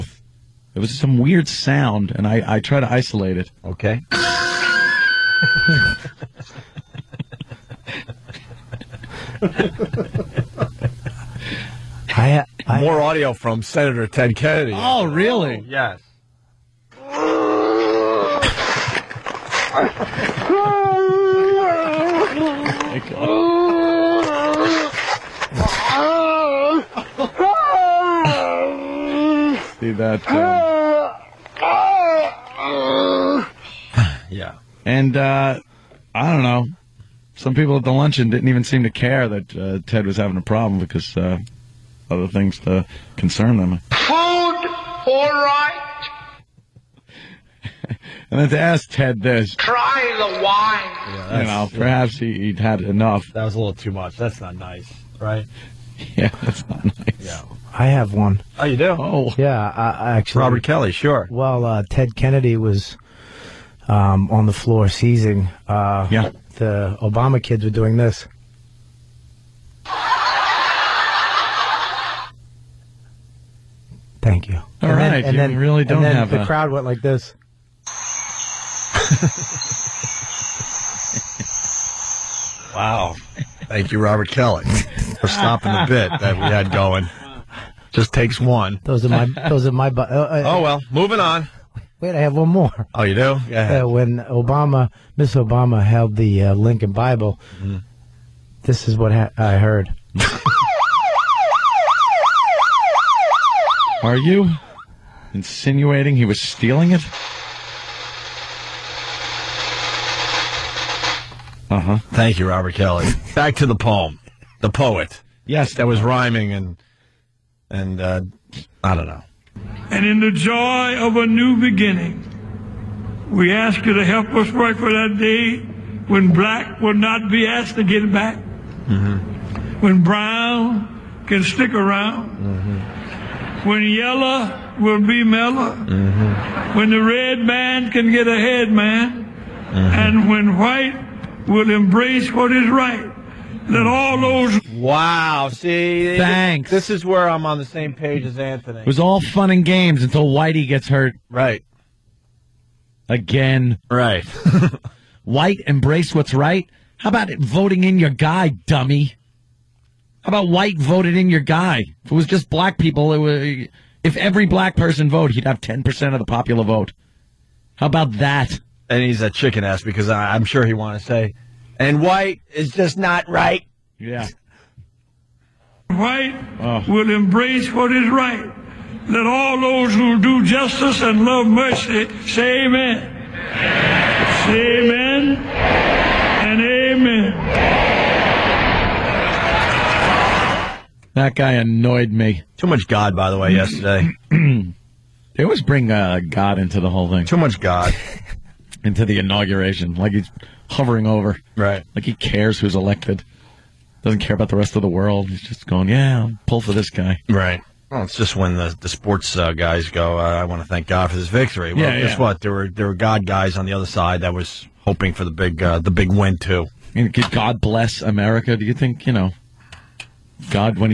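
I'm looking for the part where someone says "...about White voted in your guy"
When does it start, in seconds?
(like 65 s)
160 s.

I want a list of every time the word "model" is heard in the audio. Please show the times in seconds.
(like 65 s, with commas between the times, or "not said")
not said.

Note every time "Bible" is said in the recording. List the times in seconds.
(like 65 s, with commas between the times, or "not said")
96 s.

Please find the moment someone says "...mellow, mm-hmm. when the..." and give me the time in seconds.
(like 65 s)
135 s.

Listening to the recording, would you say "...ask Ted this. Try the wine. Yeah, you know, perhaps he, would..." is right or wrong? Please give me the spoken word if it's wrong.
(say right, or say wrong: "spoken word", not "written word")
right.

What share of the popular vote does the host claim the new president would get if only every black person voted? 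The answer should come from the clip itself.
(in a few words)
10%.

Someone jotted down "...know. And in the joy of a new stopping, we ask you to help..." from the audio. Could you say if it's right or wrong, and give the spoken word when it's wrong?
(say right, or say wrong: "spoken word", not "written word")
wrong: "beginning", not "stopping".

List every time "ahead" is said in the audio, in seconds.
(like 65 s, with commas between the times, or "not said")
138 s.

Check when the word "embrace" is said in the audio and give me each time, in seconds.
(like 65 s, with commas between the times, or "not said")
141 s, 155 s, 177 s.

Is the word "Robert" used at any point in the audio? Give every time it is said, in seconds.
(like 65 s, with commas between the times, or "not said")
60 s, 83 s, 112 s.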